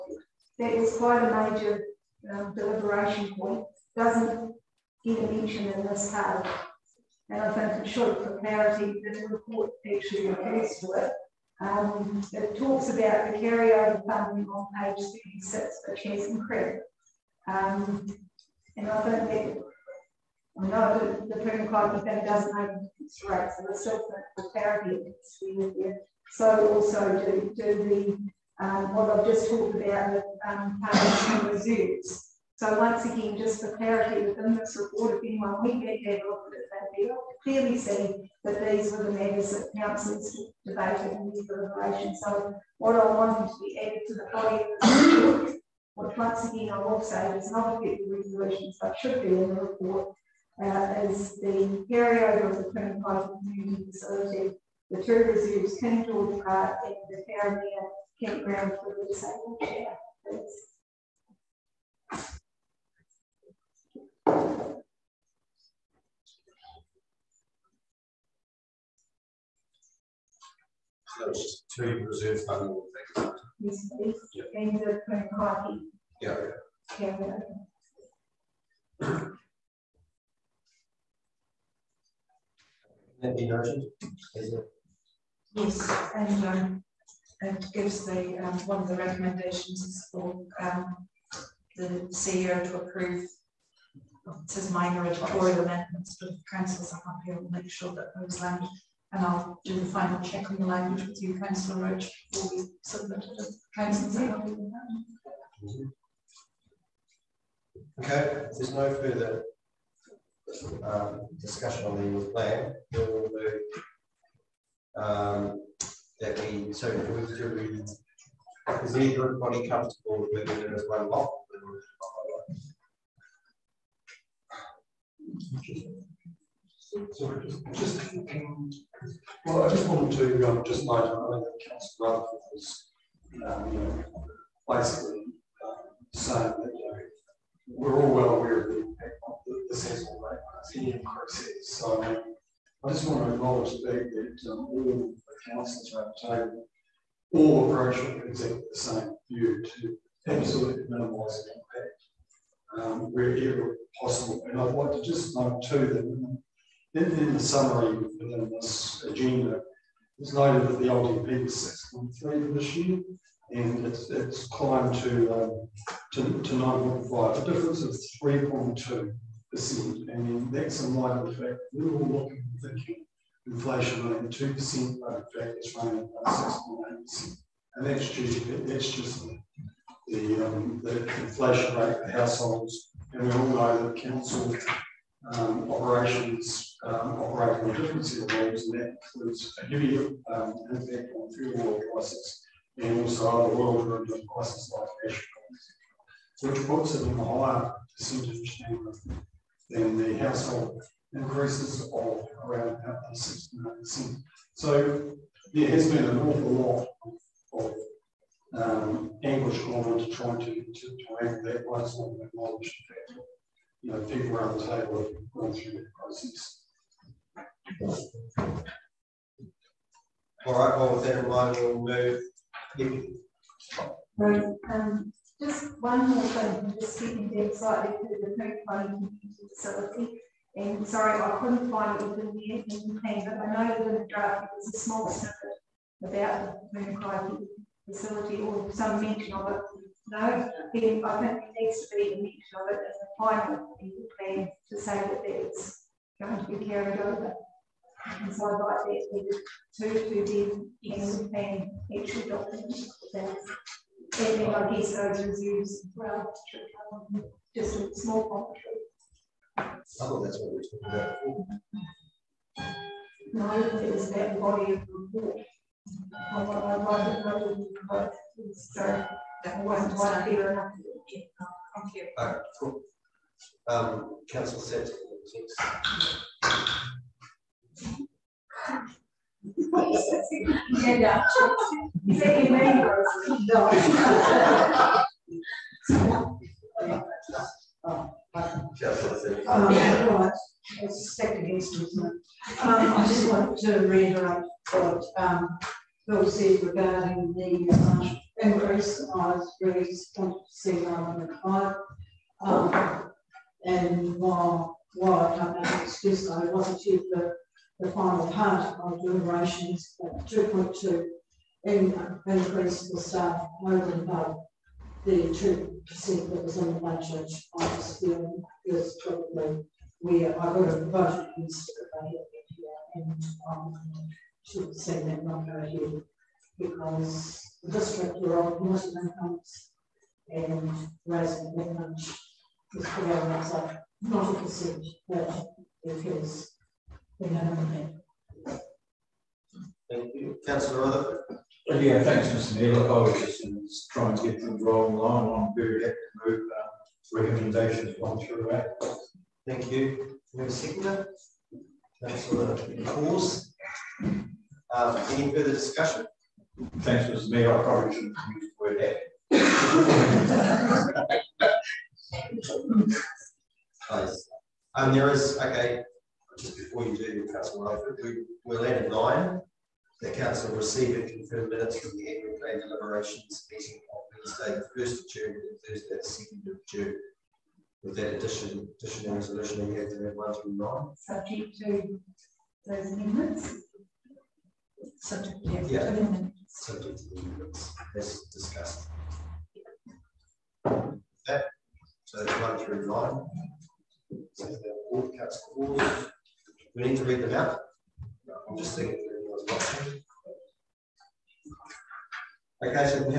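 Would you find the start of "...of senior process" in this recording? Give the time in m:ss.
2:19.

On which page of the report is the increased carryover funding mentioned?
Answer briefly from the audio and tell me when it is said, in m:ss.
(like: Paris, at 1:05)
36, at 0:15.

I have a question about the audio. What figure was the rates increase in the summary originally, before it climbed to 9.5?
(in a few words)
6.3.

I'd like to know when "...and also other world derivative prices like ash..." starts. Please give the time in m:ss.
3:12.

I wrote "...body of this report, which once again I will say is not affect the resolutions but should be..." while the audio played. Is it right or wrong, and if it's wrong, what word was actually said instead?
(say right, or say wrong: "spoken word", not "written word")
right.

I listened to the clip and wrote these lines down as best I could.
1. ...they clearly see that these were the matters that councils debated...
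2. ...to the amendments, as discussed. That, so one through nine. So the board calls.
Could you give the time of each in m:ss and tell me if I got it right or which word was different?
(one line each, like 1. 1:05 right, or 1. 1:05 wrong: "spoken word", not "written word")
1. 0:37 right
2. 6:26 right.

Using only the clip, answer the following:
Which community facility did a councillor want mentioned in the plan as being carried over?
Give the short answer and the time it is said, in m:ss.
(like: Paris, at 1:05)
Pink Valley Community Facility, at 3:48.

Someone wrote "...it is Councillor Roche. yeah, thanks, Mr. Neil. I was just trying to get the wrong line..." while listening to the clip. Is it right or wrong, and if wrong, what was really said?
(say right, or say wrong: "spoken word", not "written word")
wrong: "Rutherford", not "Roche".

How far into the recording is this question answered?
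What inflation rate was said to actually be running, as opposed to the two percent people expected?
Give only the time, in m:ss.
2:56.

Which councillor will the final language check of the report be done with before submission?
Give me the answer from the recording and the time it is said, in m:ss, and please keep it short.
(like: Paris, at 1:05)
Councillor Roche, at 1:41.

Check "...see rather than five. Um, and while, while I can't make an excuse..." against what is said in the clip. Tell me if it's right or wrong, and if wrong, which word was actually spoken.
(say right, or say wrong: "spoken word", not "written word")
right.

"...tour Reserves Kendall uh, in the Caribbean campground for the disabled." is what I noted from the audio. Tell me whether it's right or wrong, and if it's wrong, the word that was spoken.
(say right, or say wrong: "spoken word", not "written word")
right.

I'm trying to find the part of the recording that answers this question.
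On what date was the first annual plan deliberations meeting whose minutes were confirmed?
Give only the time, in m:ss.
6:14.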